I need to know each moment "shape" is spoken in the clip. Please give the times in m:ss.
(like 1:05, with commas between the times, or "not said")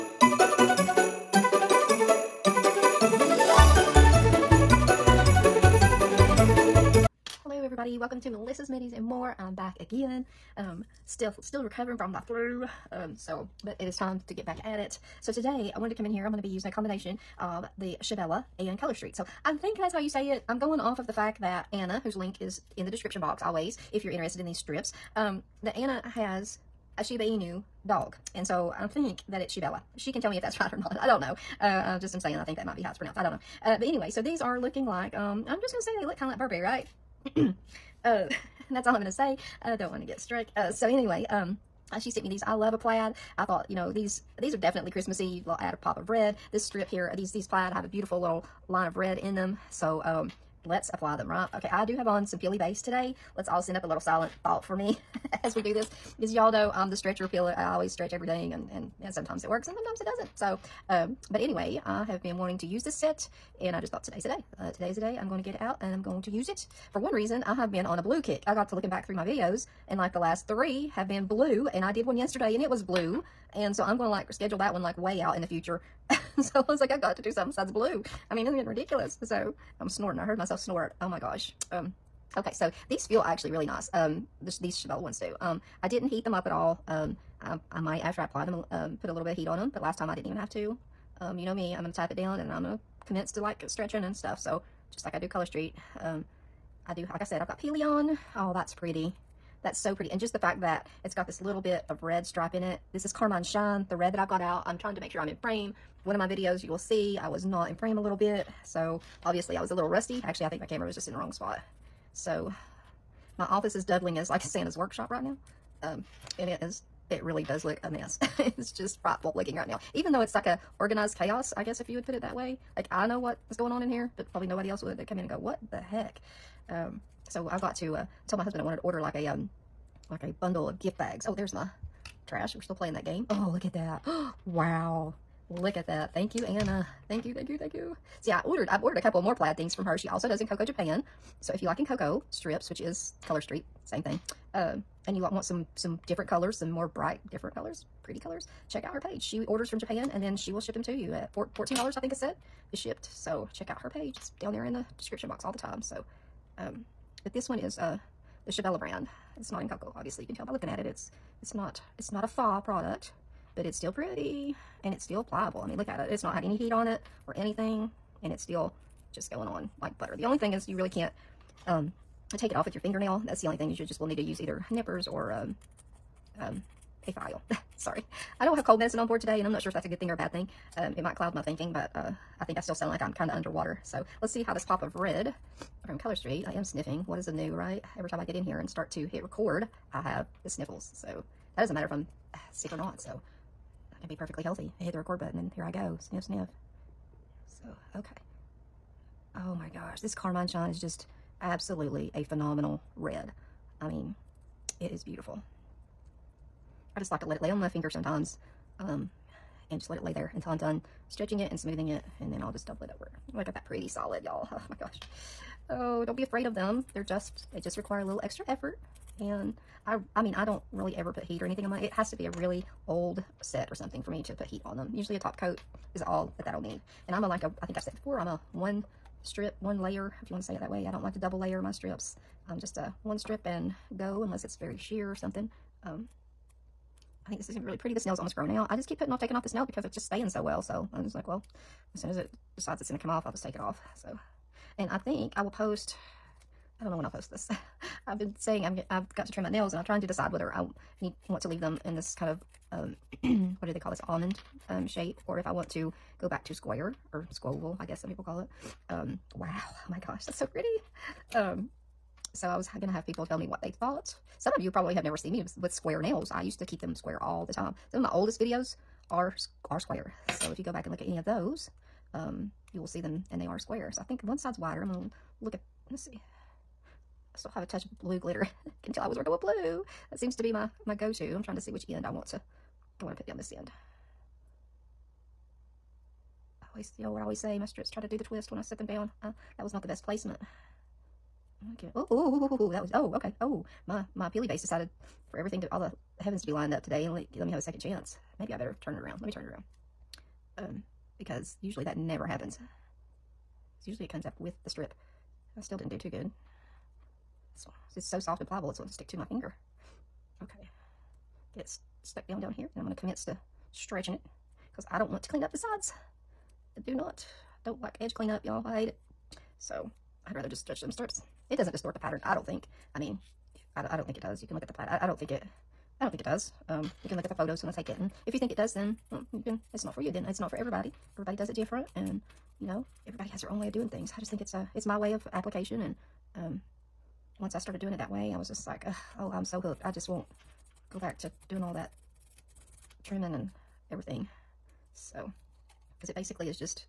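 4:14.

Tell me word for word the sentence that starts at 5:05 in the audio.
I still didn't do too good.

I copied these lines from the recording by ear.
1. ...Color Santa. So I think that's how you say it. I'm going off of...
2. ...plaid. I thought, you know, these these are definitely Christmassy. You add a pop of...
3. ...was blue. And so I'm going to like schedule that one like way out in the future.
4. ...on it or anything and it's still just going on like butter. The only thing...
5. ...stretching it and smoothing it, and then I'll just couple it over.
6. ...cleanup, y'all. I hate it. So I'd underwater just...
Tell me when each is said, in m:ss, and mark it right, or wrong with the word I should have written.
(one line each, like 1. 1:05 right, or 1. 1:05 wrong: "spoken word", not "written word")
1. 0:18 wrong: "Street", not "Santa"
2. 0:42 right
3. 1:12 right
4. 2:46 right
5. 3:31 wrong: "double", not "couple"
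6. 5:18 wrong: "rather", not "underwater".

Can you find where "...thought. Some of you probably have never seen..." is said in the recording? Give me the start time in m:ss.
4:23.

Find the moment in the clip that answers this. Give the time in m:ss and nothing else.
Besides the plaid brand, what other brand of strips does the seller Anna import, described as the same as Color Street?
2:20.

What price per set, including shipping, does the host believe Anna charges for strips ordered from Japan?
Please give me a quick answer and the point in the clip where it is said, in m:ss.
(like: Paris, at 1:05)
$14, at 2:31.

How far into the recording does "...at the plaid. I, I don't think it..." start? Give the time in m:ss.
5:24.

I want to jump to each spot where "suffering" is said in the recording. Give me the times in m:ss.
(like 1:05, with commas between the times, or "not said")
not said.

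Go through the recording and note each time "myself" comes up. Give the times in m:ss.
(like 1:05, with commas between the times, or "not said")
1:20.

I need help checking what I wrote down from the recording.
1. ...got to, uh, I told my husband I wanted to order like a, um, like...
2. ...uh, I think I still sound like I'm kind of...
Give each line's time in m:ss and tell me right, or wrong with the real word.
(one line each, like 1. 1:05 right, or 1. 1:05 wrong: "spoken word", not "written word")
1. 2:07 right
2. 3:01 right.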